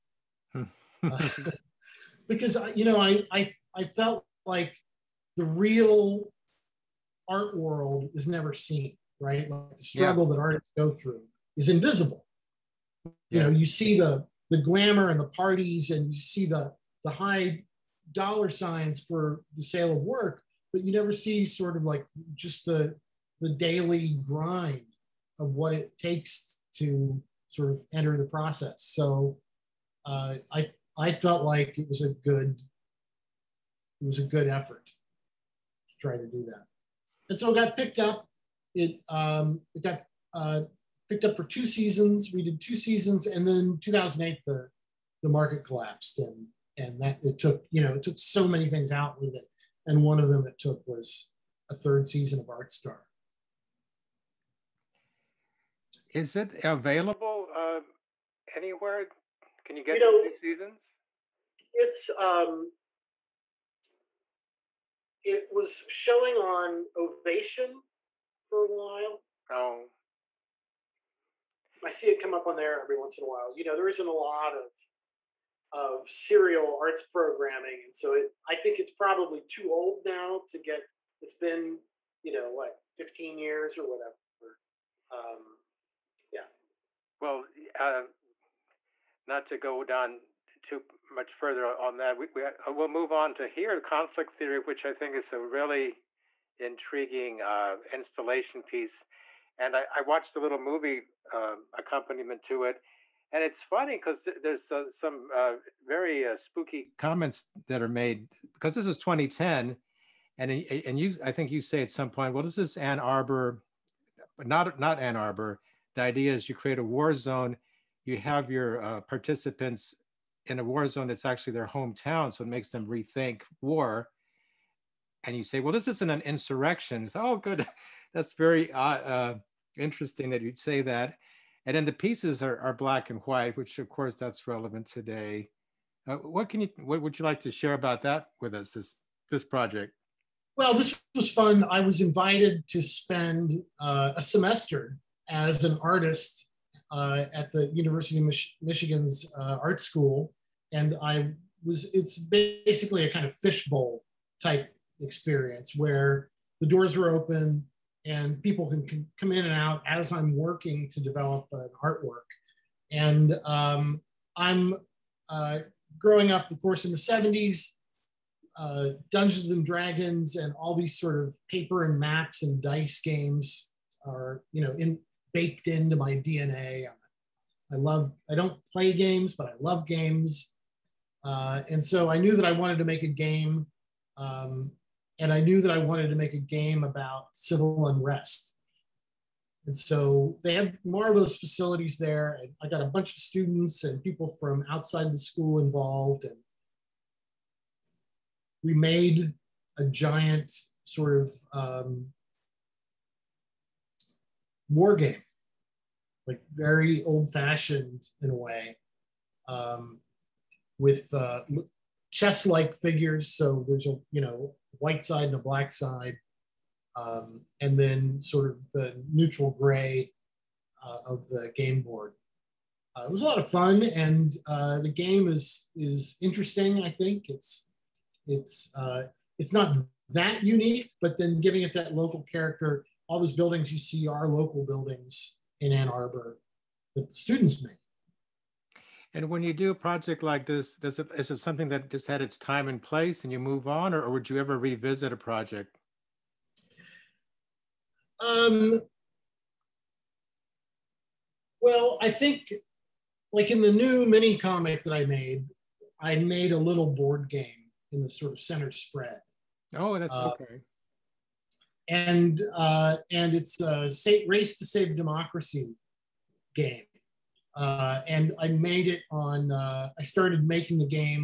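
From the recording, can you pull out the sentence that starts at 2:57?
I love, I don't play games, but I love games.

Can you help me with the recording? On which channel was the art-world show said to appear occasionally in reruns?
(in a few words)
Ovation.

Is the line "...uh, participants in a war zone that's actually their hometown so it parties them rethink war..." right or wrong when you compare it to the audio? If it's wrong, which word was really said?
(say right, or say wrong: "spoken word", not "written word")
wrong: "makes", not "parties".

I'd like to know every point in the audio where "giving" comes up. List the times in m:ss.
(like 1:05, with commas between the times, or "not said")
3:51.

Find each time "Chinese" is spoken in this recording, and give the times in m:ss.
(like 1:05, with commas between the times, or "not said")
not said.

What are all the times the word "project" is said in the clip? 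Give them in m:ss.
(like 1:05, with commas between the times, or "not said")
2:19, 3:59, 4:05.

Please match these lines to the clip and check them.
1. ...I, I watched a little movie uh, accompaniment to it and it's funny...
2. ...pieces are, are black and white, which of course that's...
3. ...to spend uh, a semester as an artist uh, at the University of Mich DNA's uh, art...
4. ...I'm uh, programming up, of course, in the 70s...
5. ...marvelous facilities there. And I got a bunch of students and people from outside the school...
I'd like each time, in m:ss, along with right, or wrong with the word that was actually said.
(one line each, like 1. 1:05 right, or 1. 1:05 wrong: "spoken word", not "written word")
1. 1:39 right
2. 2:11 right
3. 2:22 wrong: "Michigan", not "DNA"
4. 2:44 wrong: "growing", not "programming"
5. 3:10 right.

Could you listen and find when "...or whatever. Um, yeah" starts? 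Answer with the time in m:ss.
1:23.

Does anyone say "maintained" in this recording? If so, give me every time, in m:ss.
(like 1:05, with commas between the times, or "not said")
not said.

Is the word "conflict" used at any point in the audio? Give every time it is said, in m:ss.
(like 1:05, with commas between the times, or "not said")
1:33.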